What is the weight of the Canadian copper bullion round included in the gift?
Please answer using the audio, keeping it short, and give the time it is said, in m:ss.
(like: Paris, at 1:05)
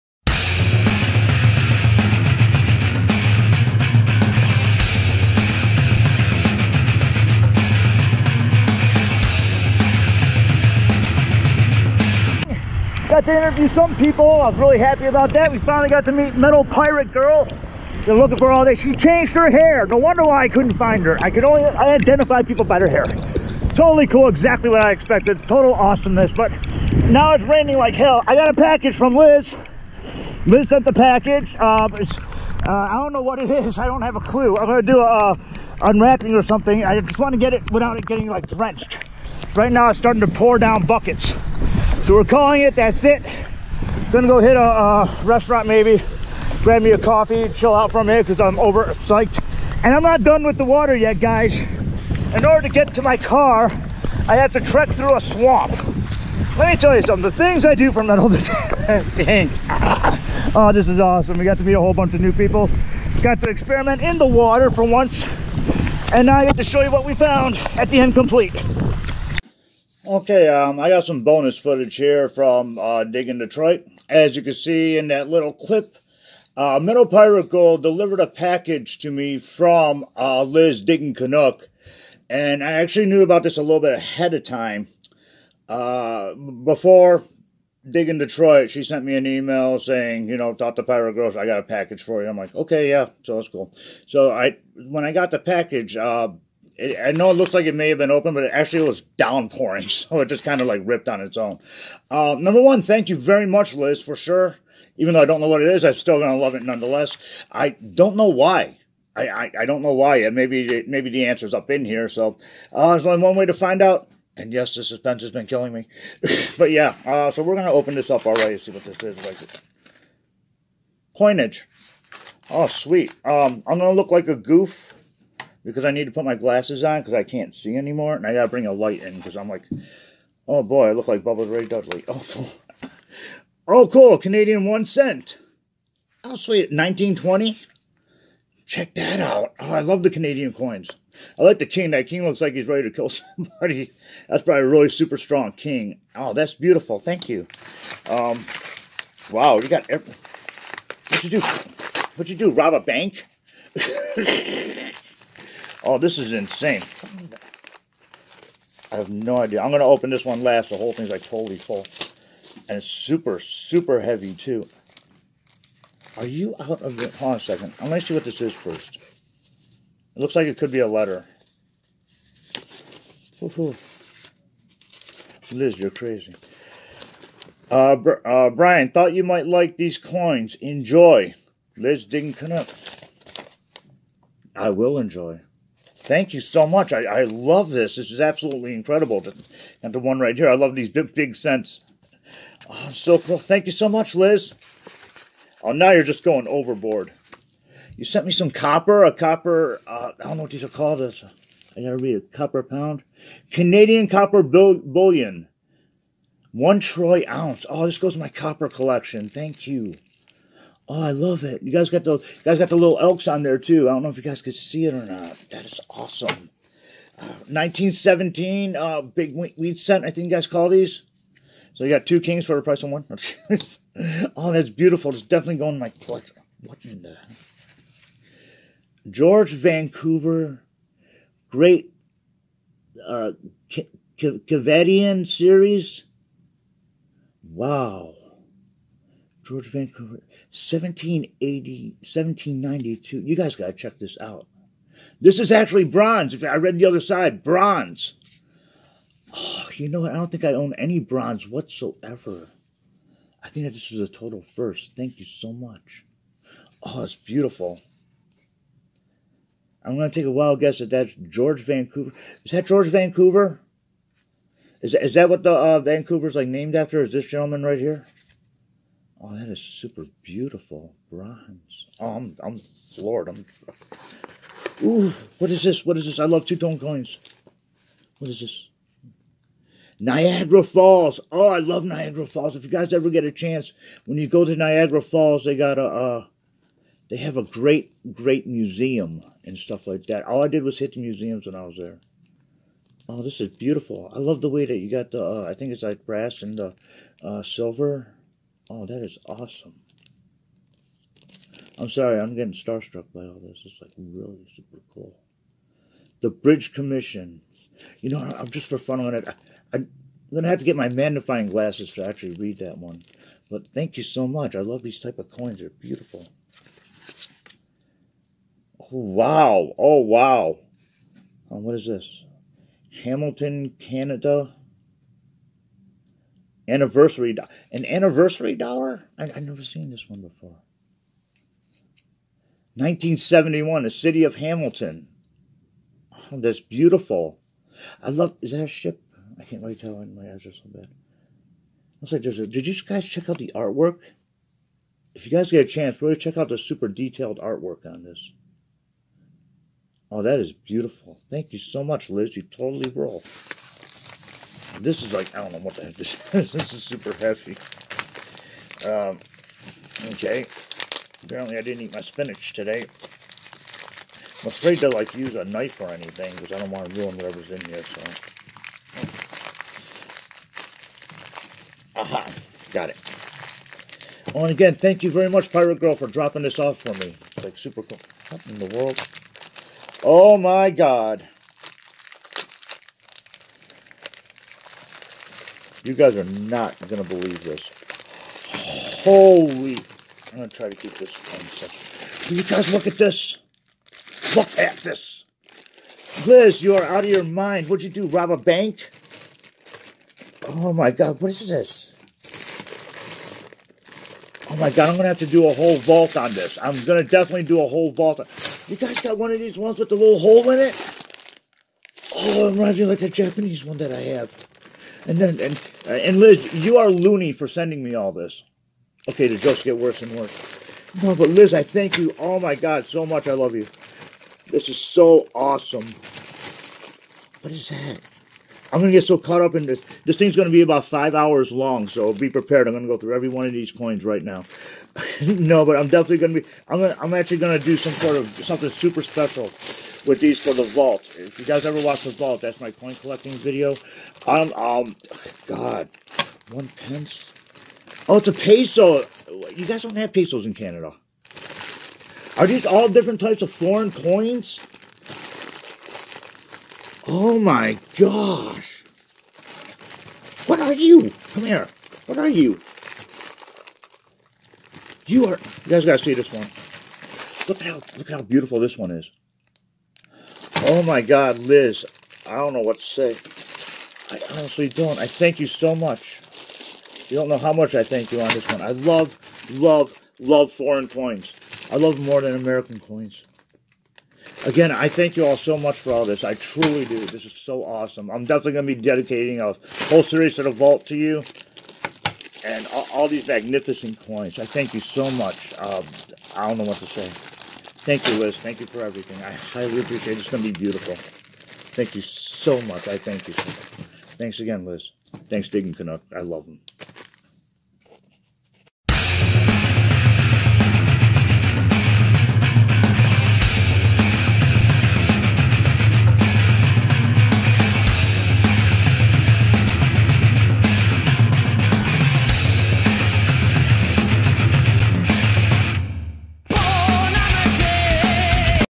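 One troy ounce, at 3:26.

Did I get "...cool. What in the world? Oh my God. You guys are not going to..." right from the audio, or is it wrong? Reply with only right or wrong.
right.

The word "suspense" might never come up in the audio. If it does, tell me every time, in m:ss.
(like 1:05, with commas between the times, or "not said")
1:54.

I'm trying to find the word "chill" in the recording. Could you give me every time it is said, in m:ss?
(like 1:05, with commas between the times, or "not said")
0:47.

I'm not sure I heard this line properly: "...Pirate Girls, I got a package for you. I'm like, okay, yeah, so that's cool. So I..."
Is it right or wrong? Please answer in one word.
right.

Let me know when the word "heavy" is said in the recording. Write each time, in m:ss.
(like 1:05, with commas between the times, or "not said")
2:43.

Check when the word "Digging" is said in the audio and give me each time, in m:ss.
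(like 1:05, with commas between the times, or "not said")
1:13, 1:20, 1:27, 3:02, 8:25.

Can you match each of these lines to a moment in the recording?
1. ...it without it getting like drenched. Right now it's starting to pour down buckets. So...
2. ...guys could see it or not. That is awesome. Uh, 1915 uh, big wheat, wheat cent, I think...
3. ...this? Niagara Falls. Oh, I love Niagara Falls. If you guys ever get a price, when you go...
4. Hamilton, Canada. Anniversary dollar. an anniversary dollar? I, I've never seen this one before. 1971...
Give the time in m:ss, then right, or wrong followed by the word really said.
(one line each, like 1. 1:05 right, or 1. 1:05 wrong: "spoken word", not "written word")
1. 0:37 right
2. 3:34 wrong: "1917", not "1915"
3. 4:38 wrong: "chance", not "price"
4. 5:23 right.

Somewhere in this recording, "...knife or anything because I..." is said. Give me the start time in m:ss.
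6:05.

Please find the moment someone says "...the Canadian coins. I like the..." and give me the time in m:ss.
2:20.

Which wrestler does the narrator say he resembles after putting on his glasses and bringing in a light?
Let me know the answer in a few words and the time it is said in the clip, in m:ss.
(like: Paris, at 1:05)
Bubba Ray Dudley, at 2:11.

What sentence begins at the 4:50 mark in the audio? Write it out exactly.
All I did was hit the museums when I was there.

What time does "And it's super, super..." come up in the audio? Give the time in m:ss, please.
2:42.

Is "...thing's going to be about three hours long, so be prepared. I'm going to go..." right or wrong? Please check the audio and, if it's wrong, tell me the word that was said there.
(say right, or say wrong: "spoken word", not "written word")
wrong: "five", not "three".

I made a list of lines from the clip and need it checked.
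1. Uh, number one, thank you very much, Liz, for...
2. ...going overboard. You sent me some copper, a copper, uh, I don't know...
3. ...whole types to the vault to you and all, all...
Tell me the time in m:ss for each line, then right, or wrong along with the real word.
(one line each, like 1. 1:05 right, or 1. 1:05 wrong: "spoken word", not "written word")
1. 1:42 right
2. 3:16 right
3. 8:09 wrong: "series", not "types".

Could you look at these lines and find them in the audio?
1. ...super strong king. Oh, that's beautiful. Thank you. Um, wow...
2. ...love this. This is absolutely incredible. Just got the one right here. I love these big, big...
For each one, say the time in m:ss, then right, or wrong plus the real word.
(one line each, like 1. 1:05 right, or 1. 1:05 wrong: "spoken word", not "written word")
1. 2:24 right
2. 3:07 right.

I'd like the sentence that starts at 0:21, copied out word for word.
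I could only identify people by their hair.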